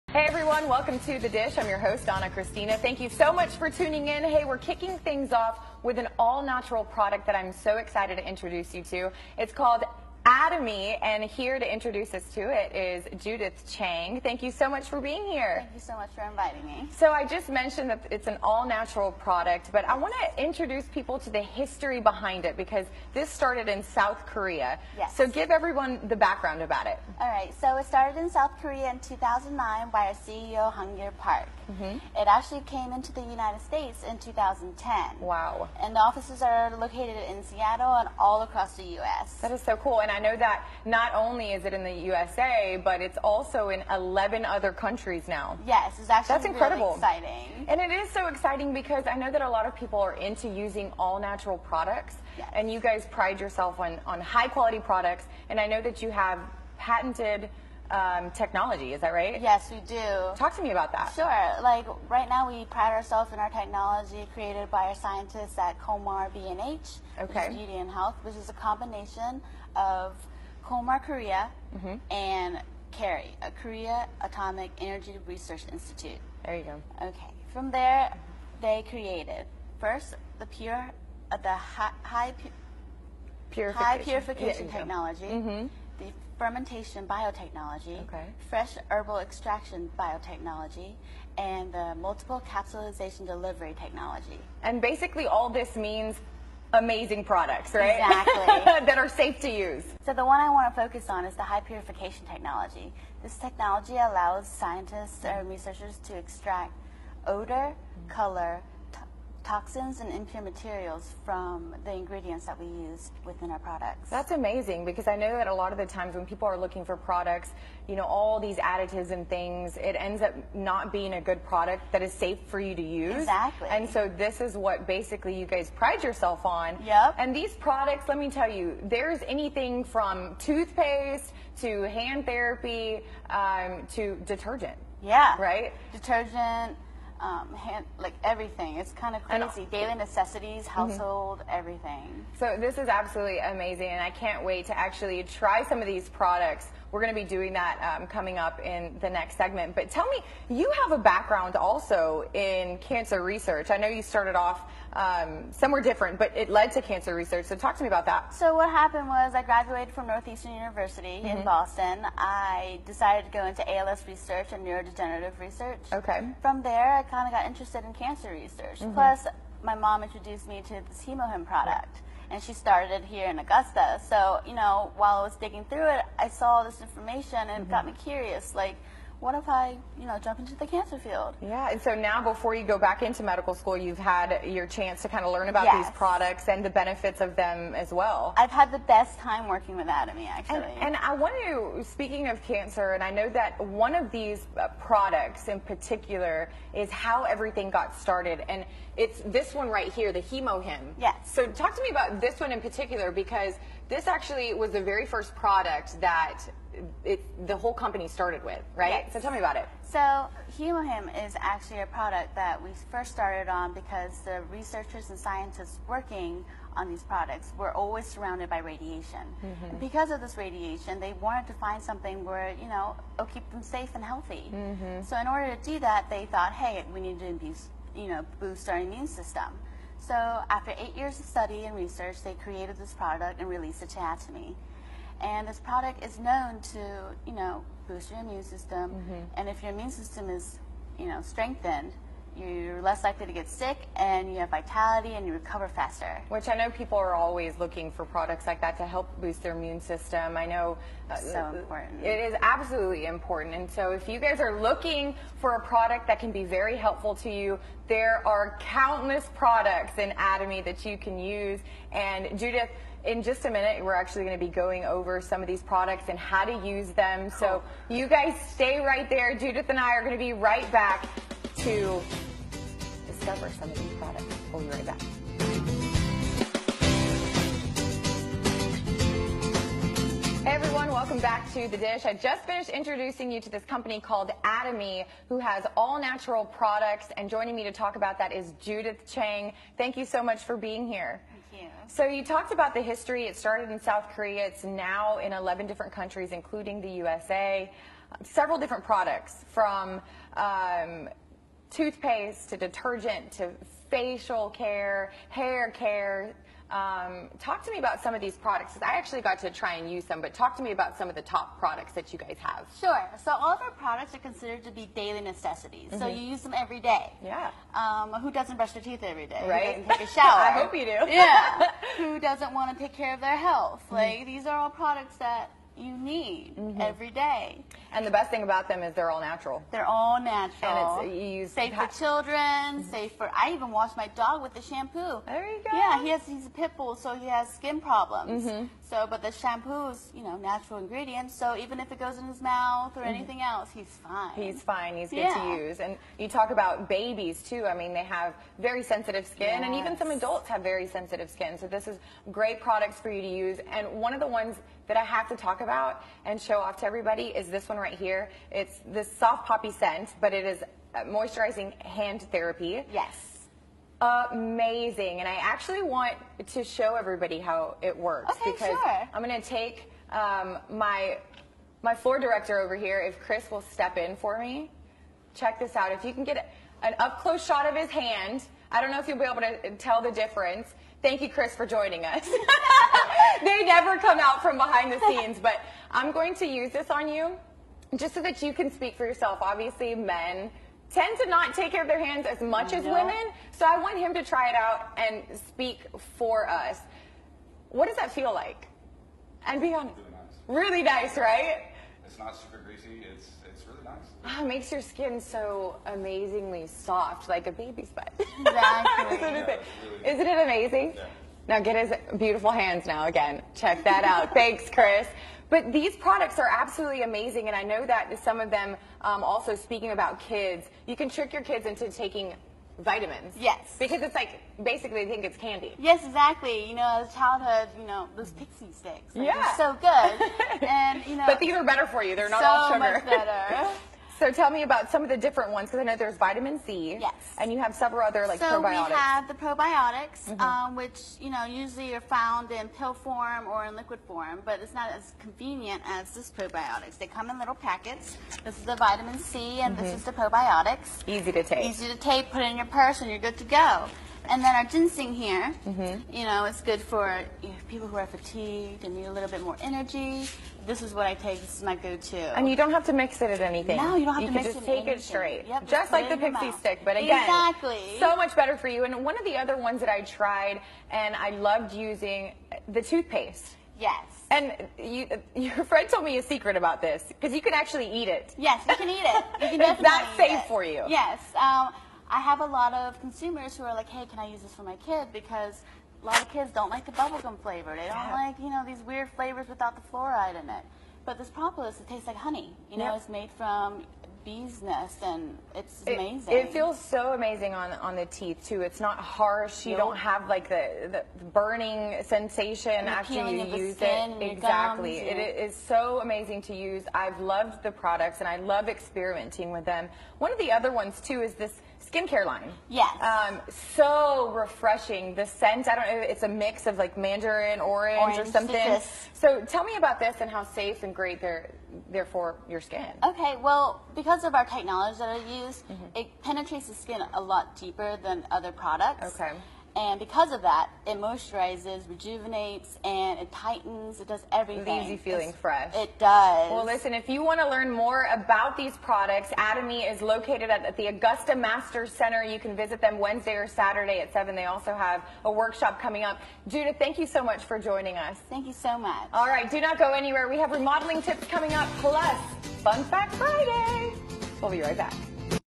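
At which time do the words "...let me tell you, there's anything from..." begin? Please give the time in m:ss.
2:08.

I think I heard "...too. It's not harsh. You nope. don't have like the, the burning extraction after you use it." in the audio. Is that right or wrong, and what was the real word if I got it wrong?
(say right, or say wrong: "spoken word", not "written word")
wrong: "sensation", not "extraction".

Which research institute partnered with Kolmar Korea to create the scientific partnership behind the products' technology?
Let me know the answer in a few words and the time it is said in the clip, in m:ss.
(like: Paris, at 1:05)
Korea Atomic Energy Research Institute, at 1:13.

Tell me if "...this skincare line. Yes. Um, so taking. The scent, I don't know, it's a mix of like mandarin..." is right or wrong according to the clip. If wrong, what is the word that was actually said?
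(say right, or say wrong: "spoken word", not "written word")
wrong: "refreshing", not "taking".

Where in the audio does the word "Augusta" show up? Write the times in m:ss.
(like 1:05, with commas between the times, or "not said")
2:53, 9:00.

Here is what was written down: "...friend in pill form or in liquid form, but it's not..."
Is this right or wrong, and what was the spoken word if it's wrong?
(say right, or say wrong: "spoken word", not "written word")
wrong: "found", not "friend".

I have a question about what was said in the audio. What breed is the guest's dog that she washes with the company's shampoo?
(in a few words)
Pit bull.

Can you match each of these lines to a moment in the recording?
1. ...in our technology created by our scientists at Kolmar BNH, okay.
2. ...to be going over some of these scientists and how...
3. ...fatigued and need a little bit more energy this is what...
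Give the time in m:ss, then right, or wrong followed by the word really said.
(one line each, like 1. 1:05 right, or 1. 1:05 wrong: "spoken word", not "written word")
1. 1:03 right
2. 4:24 wrong: "products", not "scientists"
3. 7:38 right.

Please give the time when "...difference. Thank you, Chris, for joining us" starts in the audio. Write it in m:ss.
6:20.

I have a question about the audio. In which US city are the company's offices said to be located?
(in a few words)
Seattle.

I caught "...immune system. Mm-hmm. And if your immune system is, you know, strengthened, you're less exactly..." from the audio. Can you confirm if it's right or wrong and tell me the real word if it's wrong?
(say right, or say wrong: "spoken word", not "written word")
wrong: "likely", not "exactly".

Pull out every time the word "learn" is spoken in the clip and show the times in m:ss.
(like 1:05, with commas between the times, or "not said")
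3:05, 8:57.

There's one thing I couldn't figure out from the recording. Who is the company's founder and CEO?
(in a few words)
Han-gill Park.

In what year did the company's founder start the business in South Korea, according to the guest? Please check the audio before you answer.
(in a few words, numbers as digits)
2009.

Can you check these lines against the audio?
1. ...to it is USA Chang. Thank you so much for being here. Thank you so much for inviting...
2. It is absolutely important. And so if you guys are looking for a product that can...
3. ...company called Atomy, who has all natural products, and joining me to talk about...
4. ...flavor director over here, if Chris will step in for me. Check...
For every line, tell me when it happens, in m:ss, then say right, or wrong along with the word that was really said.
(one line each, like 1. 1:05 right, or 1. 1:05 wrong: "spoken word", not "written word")
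1. 0:12 wrong: "Judith", not "USA"
2. 4:12 right
3. 4:43 right
4. 6:11 wrong: "floor", not "flavor".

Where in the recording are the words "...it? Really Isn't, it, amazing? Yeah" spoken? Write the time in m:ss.
6:49.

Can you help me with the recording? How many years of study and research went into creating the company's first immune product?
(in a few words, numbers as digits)
8.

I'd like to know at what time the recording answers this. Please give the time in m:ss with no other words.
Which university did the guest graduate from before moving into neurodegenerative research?
2:40.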